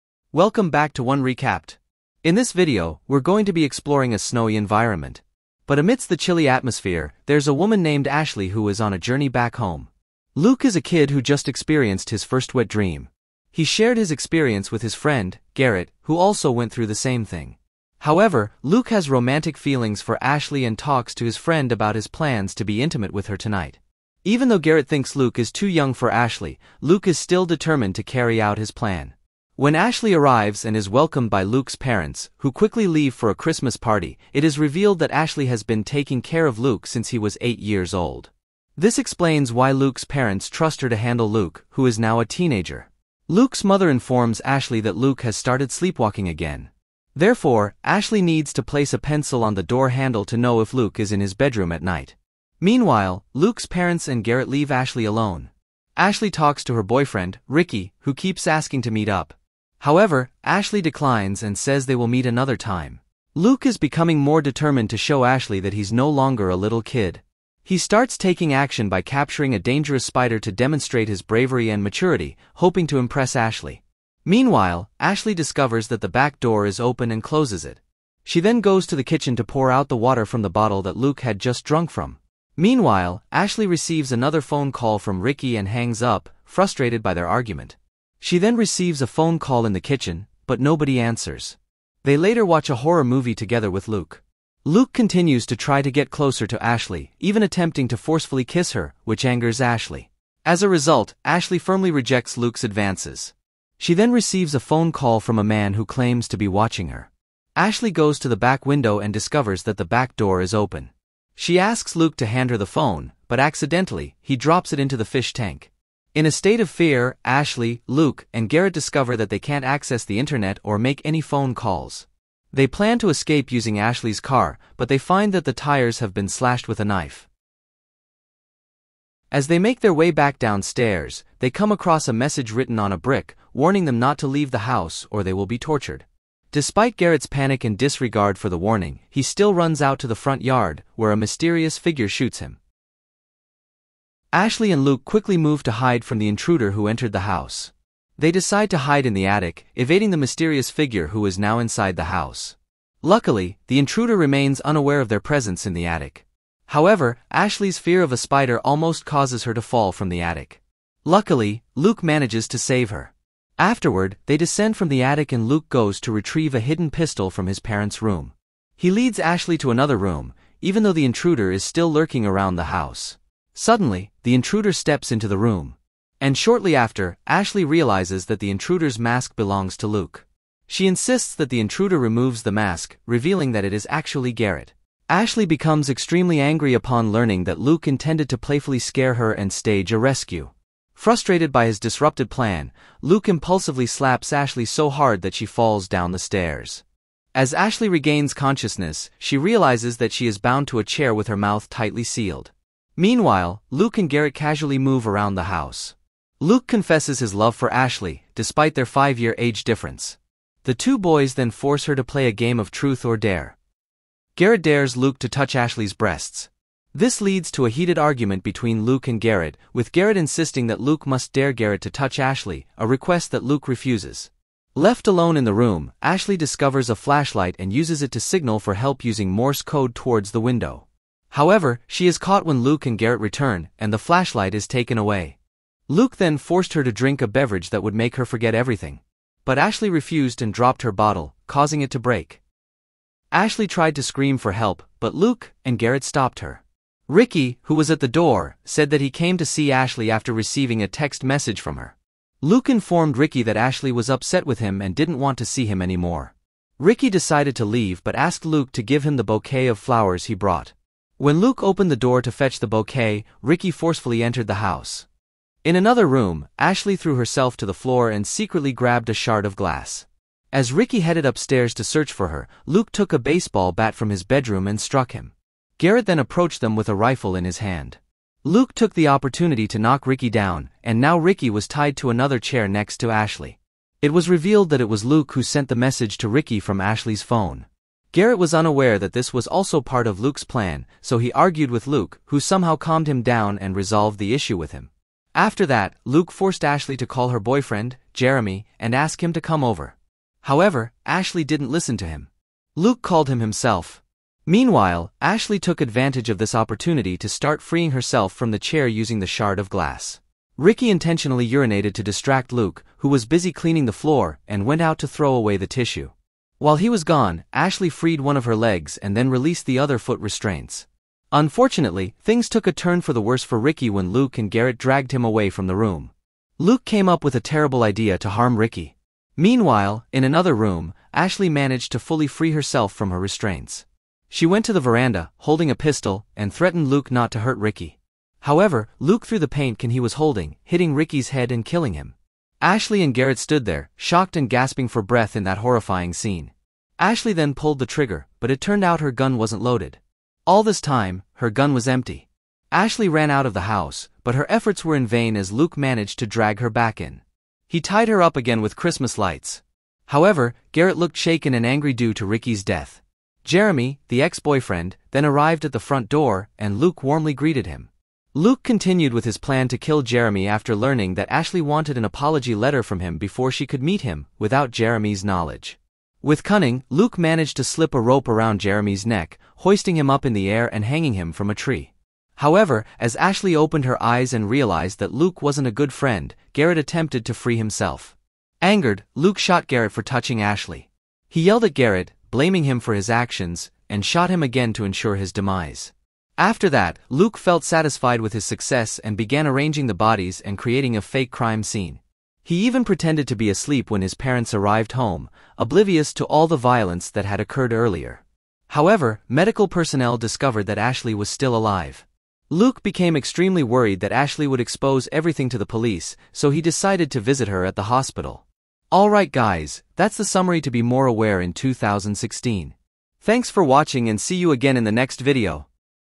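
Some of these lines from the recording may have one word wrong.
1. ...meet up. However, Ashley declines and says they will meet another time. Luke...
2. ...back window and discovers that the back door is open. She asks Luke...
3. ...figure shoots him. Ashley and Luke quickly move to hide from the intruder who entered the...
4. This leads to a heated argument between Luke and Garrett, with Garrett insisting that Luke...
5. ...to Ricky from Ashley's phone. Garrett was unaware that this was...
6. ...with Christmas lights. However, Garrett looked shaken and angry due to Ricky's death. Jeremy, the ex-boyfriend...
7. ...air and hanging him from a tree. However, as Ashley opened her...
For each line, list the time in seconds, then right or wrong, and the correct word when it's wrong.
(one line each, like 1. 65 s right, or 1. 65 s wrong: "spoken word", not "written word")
1. 58 s right
2. 108 s right
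3. 141 s right
4. 216 s right
5. 286 s right
6. 358 s right
7. 380 s right.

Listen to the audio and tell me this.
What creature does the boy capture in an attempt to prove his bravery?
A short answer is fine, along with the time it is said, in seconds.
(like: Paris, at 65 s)
A spider, at 69 s.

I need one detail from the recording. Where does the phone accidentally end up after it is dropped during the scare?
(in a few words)
The fish tank.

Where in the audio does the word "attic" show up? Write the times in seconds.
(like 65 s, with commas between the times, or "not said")
149 s, 155 s, 160 s, 165 s.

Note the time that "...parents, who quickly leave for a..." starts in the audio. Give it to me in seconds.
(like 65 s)
31 s.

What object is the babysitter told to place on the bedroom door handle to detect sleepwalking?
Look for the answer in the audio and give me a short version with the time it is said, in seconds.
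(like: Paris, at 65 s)
A pencil, at 48 s.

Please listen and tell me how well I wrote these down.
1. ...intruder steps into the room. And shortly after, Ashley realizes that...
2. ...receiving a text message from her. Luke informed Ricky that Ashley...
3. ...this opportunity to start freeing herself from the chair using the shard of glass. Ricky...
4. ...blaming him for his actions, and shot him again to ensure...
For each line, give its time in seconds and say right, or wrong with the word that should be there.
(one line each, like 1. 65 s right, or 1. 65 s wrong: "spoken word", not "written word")
1. 174 s right
2. 250 s right
3. 306 s right
4. 392 s right.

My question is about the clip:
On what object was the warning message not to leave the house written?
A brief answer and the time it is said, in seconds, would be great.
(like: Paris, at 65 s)
A brick, at 132 s.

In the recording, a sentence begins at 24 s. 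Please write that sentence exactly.
Even though Garrett thinks Luke is too young for Ashley, Luke is still determined to carry out his plan.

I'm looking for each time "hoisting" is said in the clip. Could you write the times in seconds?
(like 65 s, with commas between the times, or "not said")
379 s.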